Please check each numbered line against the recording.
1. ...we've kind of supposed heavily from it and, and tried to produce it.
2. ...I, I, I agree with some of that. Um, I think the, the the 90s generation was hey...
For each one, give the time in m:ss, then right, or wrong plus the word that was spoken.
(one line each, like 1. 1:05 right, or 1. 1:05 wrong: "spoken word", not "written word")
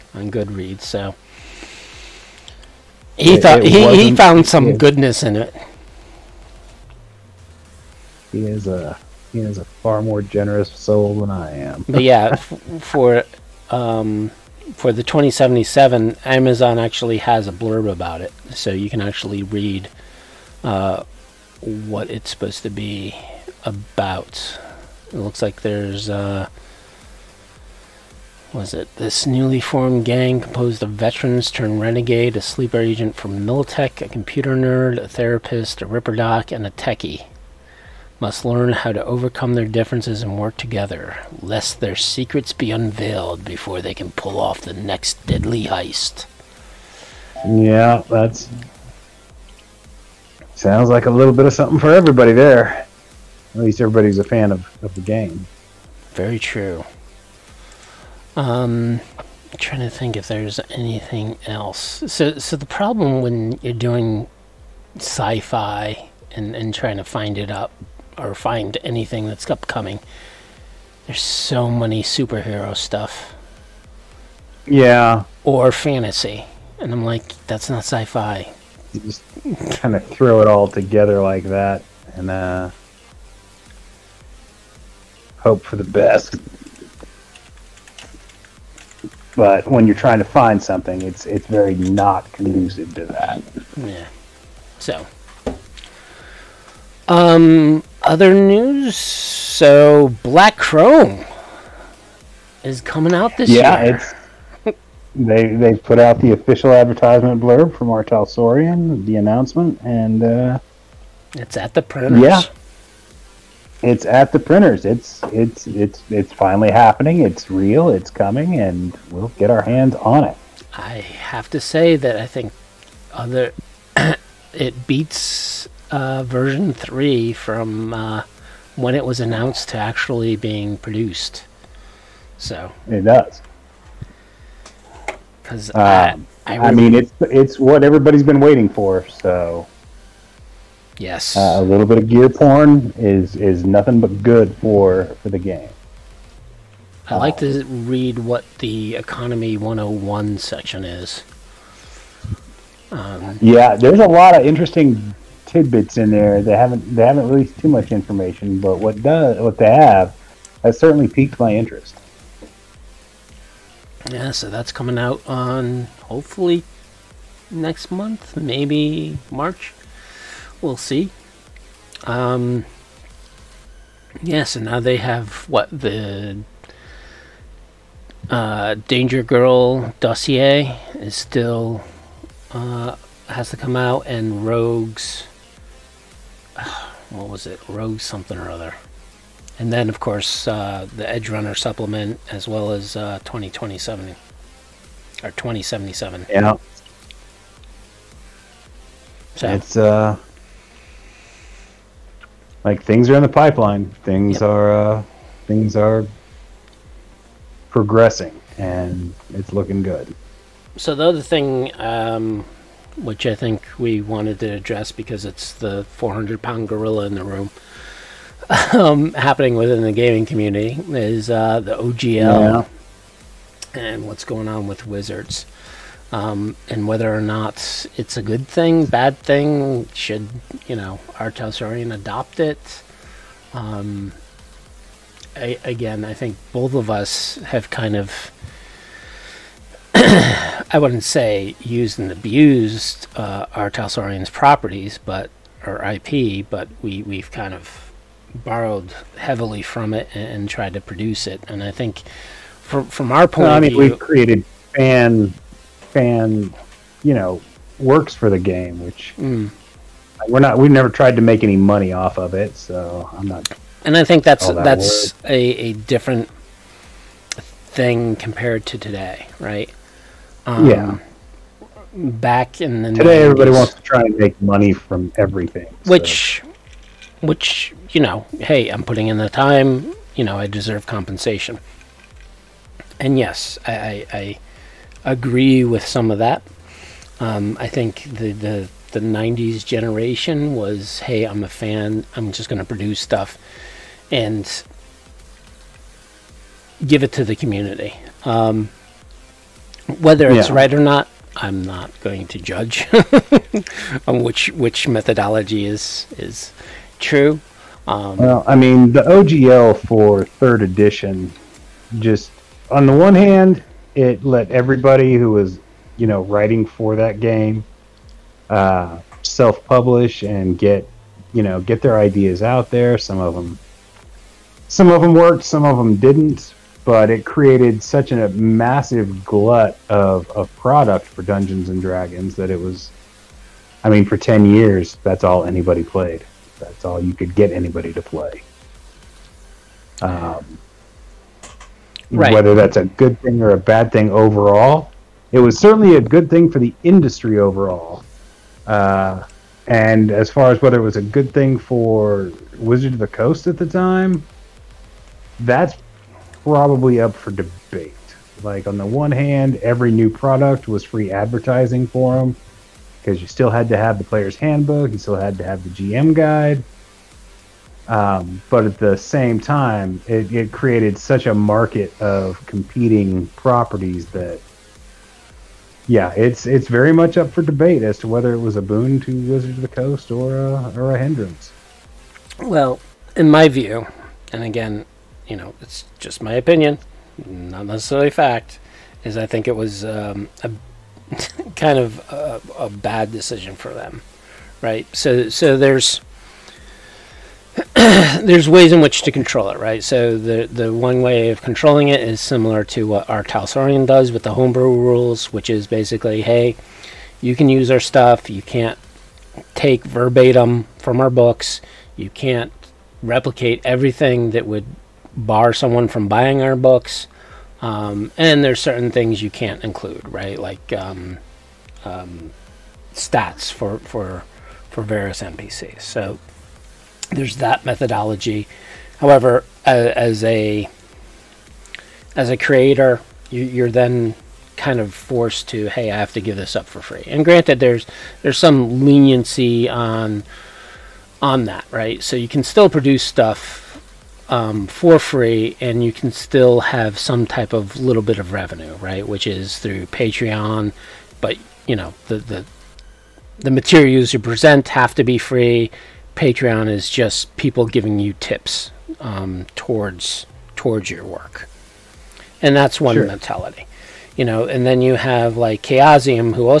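1. 4:07 wrong: "borrowed", not "supposed"
2. 4:43 right.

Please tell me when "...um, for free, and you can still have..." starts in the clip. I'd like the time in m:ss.
7:24.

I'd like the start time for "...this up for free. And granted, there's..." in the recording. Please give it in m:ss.
7:16.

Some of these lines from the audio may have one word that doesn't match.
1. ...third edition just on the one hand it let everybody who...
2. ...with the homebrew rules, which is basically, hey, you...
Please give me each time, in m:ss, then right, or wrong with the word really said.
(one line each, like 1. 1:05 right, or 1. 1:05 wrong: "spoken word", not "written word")
1. 5:10 right
2. 6:44 right.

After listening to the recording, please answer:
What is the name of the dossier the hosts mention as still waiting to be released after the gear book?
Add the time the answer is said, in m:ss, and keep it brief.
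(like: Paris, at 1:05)
Danger Girl, at 2:58.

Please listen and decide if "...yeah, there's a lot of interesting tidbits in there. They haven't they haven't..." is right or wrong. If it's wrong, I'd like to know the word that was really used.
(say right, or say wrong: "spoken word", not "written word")
right.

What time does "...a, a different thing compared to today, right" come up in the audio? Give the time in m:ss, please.
4:25.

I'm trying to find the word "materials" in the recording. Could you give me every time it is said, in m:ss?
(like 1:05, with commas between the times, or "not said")
7:33.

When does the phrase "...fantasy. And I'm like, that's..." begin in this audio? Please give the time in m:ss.
1:15.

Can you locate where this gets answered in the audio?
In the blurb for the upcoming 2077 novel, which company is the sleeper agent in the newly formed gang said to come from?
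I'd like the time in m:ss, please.
0:33.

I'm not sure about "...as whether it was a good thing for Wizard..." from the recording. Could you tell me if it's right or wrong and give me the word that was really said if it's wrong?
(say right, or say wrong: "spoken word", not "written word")
right.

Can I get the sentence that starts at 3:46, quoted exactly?
Um, and whether or not it's a good thing, bad thing, should, you know, our Telsorian adopt it?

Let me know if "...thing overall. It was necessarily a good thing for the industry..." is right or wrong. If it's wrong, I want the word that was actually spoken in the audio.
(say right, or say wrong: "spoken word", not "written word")
wrong: "certainly", not "necessarily".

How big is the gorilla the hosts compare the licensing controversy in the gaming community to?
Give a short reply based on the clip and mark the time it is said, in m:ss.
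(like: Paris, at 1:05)
400 pound, at 3:35.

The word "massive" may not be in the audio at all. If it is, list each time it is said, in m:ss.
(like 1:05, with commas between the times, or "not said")
5:28.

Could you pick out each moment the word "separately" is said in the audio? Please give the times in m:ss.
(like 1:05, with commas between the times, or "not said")
not said.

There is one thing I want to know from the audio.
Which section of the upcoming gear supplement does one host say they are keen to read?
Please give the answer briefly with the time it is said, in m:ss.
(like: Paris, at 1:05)
Economy 101, at 2:28.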